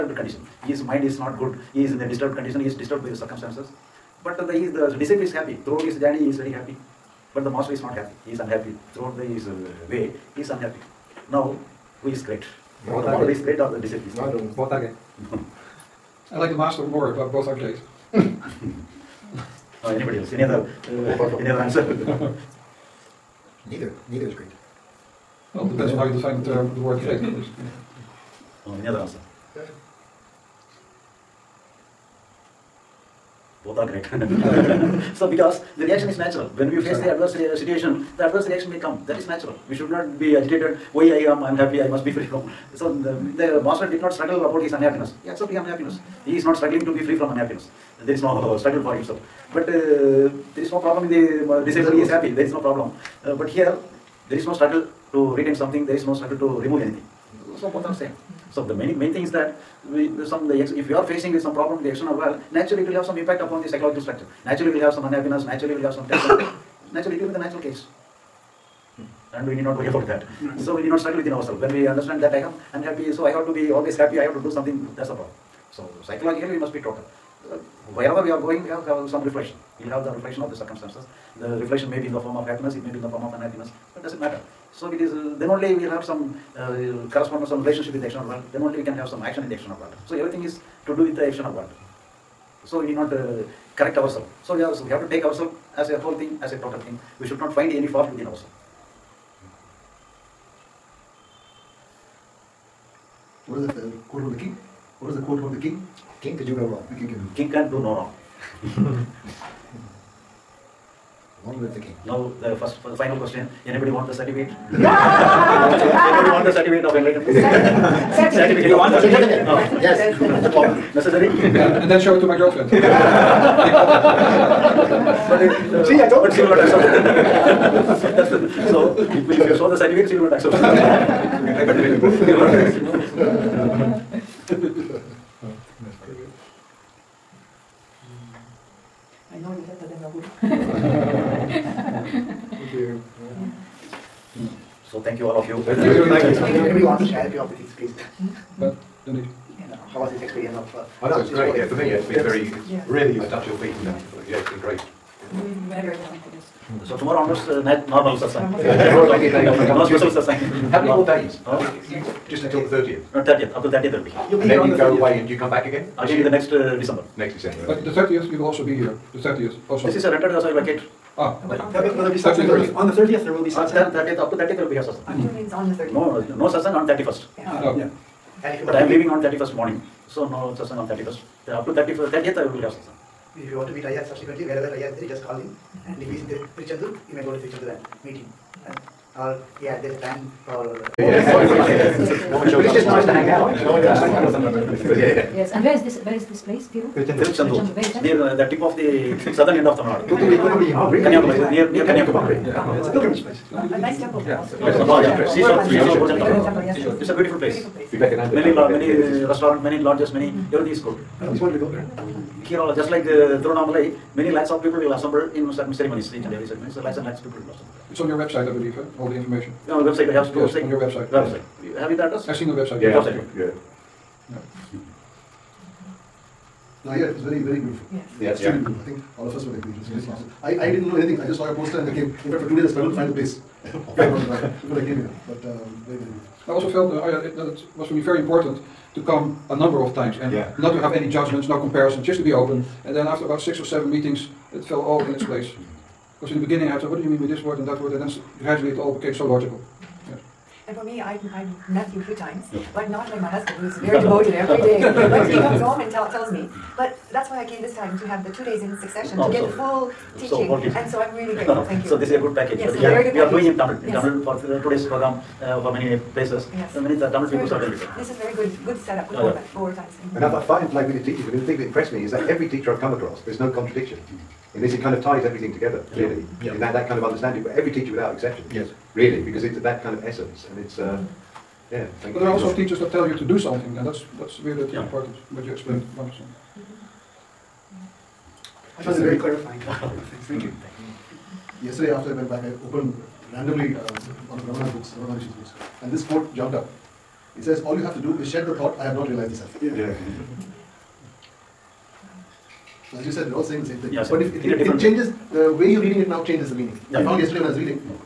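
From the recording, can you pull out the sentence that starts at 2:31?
Yeah, for me, it's been yeah.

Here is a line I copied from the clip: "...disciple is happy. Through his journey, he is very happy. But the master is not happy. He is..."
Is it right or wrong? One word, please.
right.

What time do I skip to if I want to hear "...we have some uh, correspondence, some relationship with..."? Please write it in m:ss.
1:25.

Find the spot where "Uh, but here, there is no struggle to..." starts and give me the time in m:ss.
0:53.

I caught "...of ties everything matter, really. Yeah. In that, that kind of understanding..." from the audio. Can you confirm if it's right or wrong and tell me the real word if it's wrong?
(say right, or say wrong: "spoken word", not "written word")
wrong: "together", not "matter".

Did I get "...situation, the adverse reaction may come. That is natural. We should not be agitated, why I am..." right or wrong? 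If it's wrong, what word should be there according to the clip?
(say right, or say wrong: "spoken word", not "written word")
right.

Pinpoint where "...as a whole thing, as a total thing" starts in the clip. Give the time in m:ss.
1:35.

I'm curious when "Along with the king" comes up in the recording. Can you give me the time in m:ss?
1:51.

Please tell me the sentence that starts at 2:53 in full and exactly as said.
thirtieth, up to thirtieth will be a satsang.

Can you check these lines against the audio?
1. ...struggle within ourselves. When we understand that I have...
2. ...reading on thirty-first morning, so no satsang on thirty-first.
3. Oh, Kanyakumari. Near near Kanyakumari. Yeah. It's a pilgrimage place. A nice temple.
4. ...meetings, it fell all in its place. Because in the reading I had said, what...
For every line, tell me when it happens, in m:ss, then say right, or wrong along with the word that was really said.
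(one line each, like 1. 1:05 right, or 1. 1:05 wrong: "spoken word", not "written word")
1. 1:10 right
2. 2:58 wrong: "leaving", not "reading"
3. 3:20 right
4. 4:03 wrong: "beginning", not "reading".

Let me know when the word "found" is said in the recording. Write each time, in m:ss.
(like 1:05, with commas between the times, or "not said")
4:48, 5:07.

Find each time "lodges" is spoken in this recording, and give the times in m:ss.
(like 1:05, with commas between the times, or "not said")
3:29.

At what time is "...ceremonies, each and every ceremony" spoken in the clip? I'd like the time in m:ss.
3:35.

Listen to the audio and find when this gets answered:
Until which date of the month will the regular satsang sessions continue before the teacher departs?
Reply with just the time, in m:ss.
2:43.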